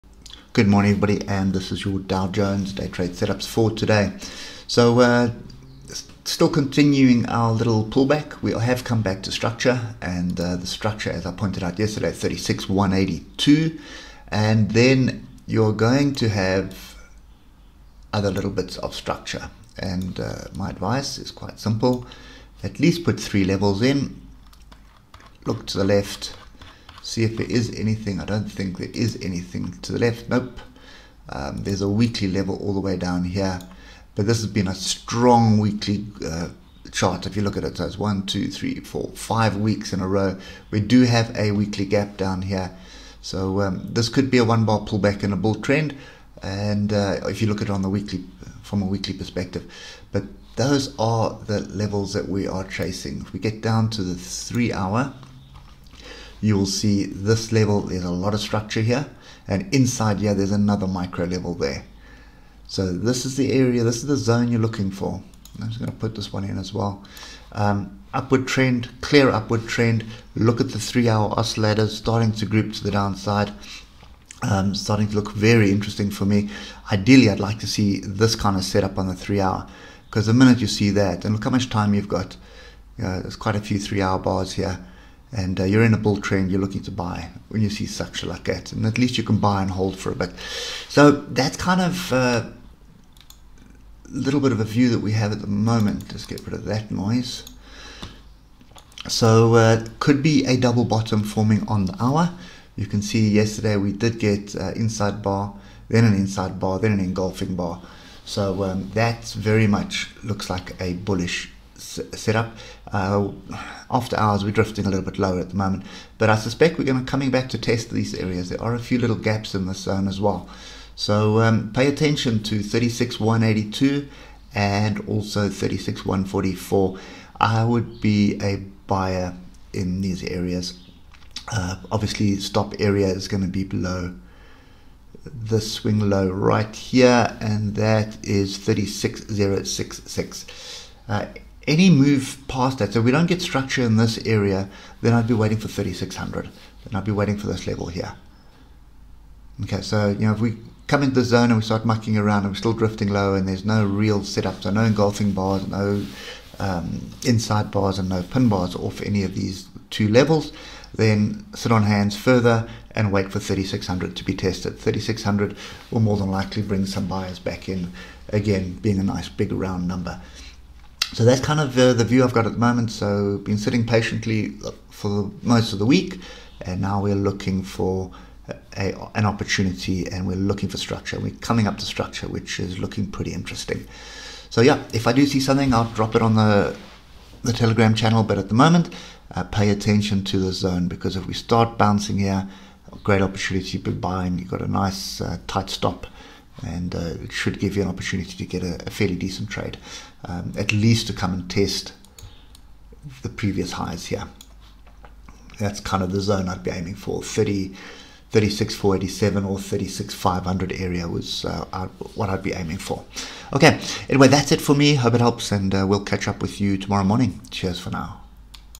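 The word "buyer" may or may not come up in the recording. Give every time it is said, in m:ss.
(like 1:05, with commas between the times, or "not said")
2:08, 2:47.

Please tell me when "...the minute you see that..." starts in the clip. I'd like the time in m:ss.
1:20.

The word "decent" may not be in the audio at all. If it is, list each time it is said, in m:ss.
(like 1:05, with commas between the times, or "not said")
3:19.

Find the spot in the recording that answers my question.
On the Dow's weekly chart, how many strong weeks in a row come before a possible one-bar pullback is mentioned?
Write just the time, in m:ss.
0:39.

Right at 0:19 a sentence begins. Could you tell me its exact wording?
And uh, my advice is quite simple: at least put three levels in.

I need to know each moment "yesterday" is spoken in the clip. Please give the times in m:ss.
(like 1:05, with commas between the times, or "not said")
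0:11, 1:43.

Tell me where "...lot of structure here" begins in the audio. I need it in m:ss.
0:58.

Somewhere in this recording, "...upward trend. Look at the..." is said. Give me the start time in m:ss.
1:09.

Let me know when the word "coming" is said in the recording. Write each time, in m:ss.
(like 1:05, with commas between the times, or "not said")
1:57, 3:01.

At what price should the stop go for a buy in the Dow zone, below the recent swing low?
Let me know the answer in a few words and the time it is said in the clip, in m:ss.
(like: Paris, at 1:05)
36066, at 2:18.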